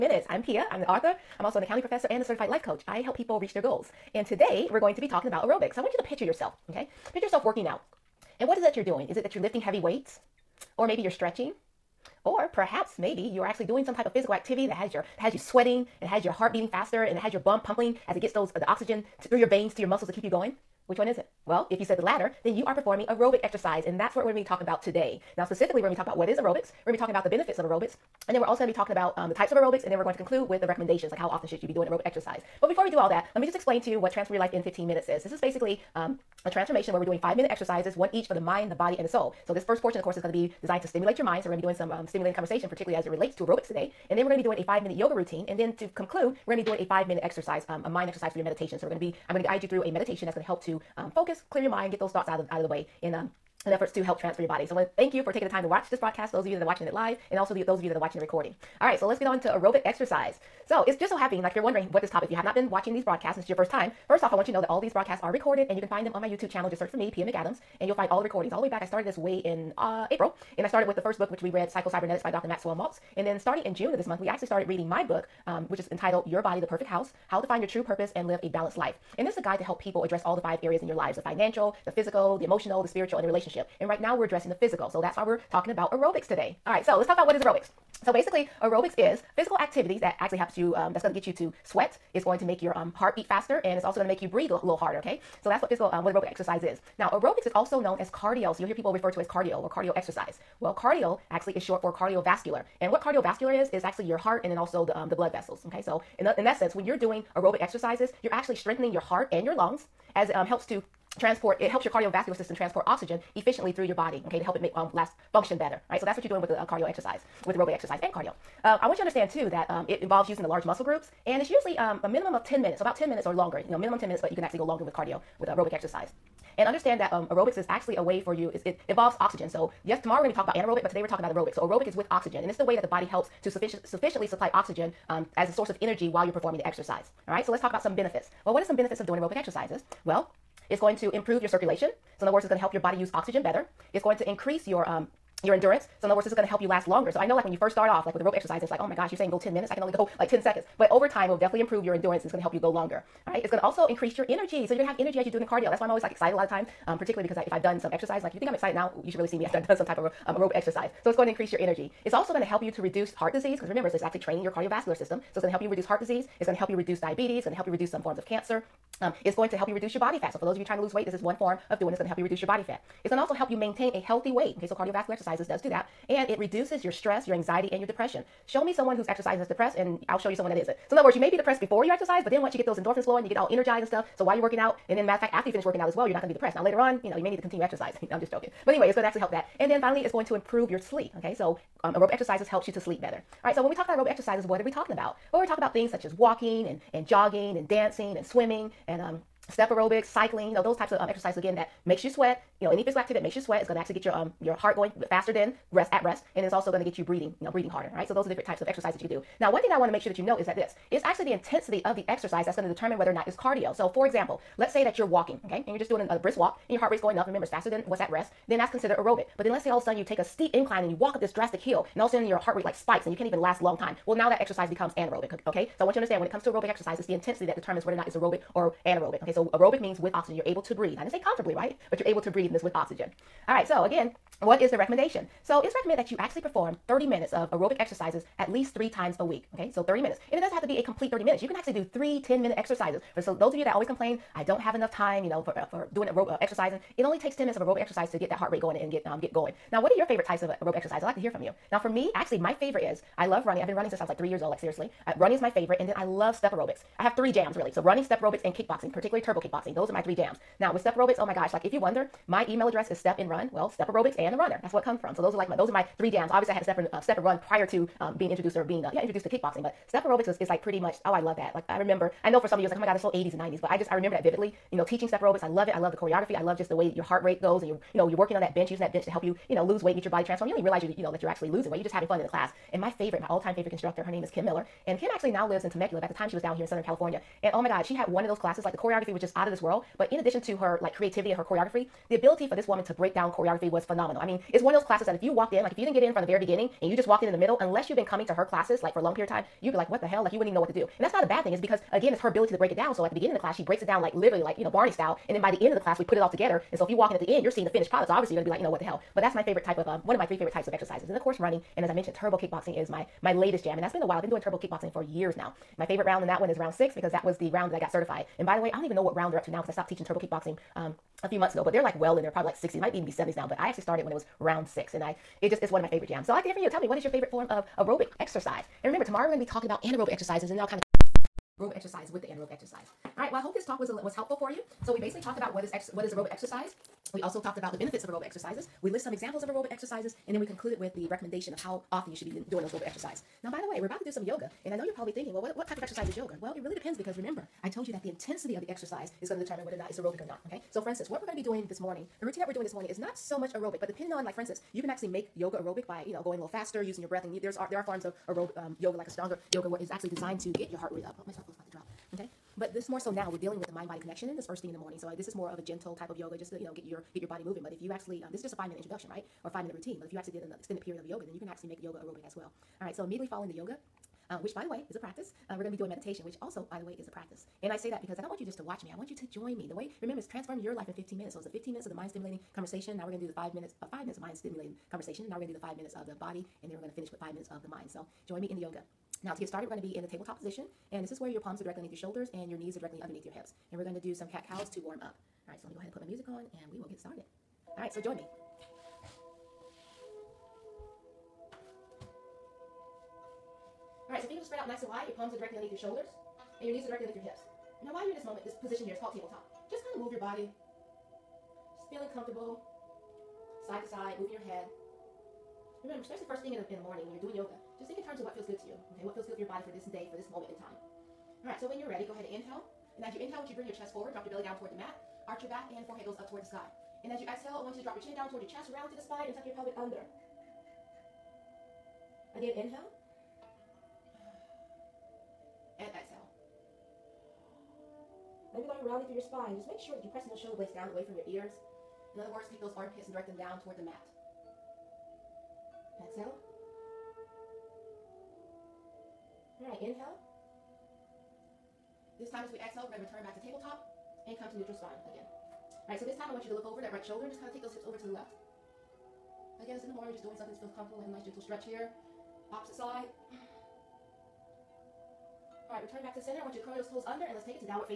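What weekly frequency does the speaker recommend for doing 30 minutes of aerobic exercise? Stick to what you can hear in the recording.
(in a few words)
3 times a week.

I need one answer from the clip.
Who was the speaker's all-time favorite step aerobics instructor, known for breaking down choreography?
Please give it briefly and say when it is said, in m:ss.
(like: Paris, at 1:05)
Kim Miller, at 4:44.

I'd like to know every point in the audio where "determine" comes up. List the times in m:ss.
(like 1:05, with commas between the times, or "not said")
3:32, 3:47, 5:49.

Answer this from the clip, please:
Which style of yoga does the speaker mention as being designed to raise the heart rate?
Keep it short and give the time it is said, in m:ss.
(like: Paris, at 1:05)
Ashtanga yoga, at 5:59.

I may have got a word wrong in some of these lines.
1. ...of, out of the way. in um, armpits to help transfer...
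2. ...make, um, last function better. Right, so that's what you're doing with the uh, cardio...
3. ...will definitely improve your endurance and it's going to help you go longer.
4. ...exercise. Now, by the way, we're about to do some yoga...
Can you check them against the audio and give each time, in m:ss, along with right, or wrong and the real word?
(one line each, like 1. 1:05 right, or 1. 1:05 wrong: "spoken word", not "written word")
1. 0:52 wrong: "efforts", not "armpits"
2. 1:54 right
3. 2:31 right
4. 5:42 right.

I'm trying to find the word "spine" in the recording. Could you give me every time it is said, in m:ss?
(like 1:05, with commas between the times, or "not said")
7:09, 7:19, 7:34.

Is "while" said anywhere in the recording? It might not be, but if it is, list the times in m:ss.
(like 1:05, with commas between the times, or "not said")
2:16, 3:04, 5:14, 6:47.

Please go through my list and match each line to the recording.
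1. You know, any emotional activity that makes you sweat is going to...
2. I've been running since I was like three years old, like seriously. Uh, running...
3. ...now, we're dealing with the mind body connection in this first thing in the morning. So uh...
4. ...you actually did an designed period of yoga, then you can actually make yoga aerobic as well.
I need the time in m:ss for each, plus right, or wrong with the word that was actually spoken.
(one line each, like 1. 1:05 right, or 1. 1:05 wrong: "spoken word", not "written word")
1. 3:22 wrong: "physical", not "emotional"
2. 4:13 right
3. 6:03 right
4. 6:10 wrong: "extended", not "designed".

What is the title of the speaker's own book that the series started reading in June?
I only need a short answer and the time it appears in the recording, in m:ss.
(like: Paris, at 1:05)
Your Body, the Perfect House, at 1:16.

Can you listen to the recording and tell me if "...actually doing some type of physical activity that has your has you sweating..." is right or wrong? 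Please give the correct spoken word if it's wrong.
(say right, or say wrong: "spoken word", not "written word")
right.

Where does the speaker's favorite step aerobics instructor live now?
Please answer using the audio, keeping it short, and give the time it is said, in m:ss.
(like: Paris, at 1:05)
Temecula, at 4:45.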